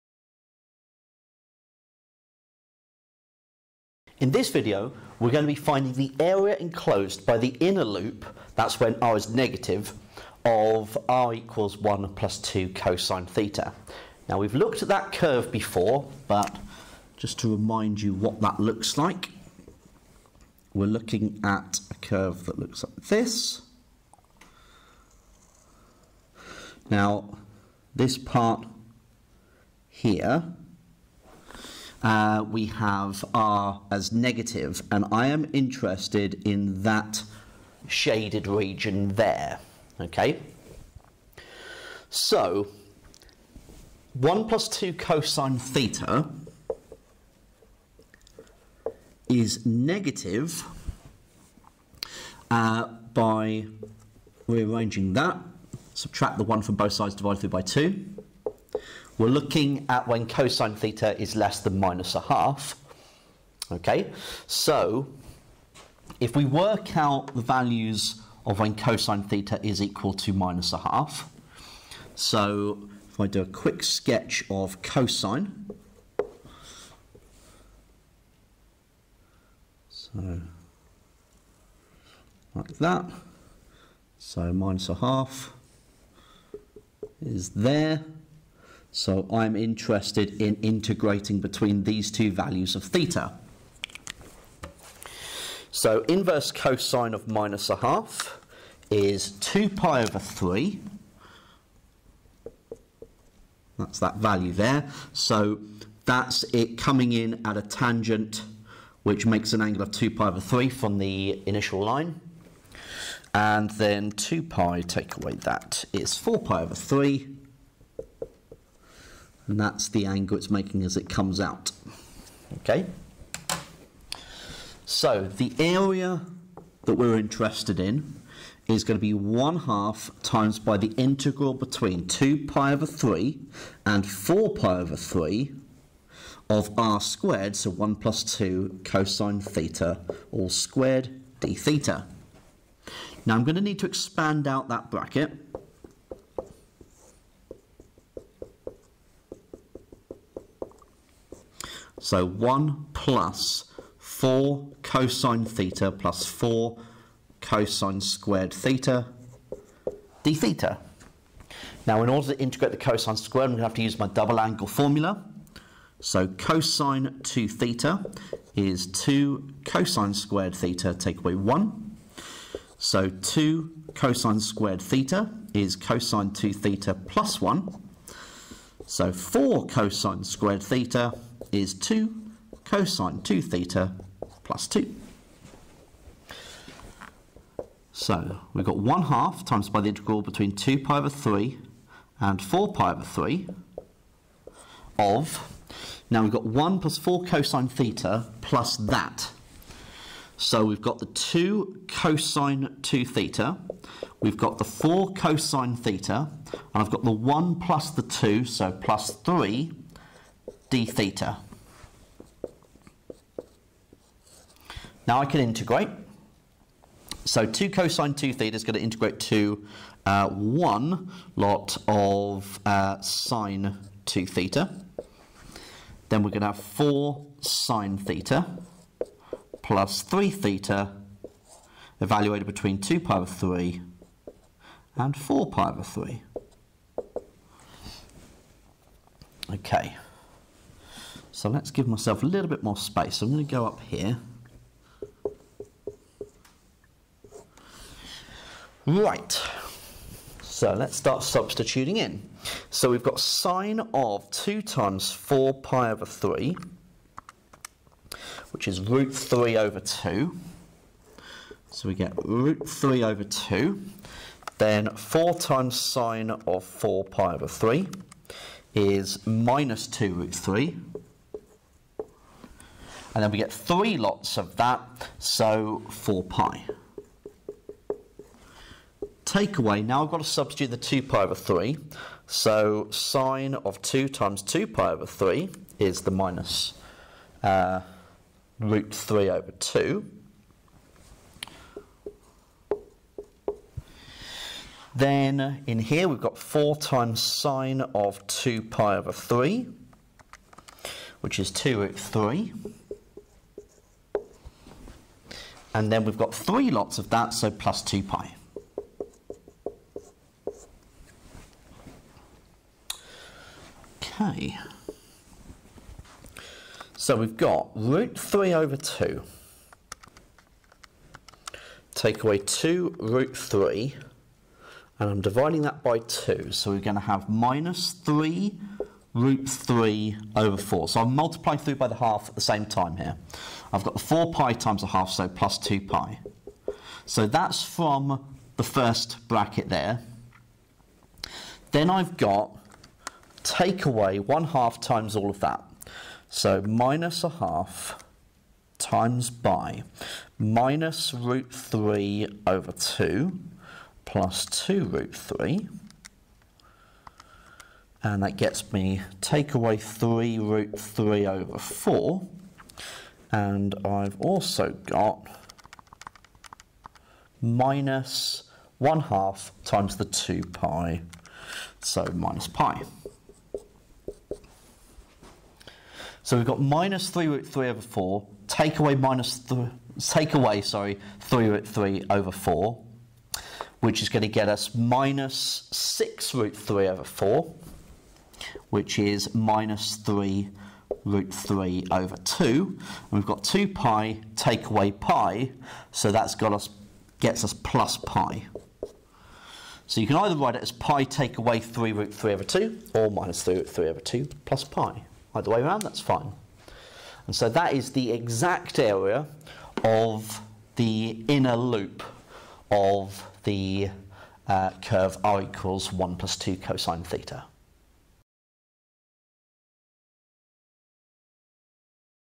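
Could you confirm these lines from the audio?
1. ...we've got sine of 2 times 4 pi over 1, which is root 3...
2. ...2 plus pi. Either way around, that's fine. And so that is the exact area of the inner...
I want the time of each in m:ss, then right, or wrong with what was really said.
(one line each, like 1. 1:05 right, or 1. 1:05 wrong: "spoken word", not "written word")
1. 4:12 wrong: "3", not "1"
2. 6:43 right.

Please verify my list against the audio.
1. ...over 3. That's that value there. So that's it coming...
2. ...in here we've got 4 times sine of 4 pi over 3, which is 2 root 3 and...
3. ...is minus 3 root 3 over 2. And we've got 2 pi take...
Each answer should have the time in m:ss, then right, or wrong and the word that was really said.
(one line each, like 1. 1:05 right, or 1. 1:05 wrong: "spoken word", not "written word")
1. 1:40 right
2. 4:55 wrong: "2", not "4"
3. 6:28 right.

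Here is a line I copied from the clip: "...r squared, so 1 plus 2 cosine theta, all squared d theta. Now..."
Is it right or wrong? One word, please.
right.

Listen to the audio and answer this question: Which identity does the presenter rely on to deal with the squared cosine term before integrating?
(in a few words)
double angle formula.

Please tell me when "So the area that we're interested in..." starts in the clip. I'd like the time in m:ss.
2:04.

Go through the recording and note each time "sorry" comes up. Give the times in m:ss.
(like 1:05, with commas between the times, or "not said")
6:20.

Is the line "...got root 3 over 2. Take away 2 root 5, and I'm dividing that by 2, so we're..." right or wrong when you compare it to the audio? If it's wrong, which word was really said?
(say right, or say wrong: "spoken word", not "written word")
wrong: "3", not "5".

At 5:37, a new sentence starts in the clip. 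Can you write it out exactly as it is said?
So that's from the first bracket there.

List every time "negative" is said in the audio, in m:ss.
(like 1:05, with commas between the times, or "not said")
0:09, 0:34, 0:49.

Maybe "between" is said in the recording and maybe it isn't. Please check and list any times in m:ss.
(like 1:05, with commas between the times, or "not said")
1:31, 2:11, 3:10, 3:52.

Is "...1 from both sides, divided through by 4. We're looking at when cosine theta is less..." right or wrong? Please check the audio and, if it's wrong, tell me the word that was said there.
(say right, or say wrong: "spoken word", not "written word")
wrong: "2", not "4".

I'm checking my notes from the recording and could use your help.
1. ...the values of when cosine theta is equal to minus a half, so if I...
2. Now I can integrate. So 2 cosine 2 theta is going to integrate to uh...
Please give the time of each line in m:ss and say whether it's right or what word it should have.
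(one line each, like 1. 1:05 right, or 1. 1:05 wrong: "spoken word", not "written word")
1. 1:07 right
2. 3:35 right.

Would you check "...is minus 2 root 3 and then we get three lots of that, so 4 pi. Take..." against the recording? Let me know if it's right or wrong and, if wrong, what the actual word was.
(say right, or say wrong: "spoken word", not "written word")
right.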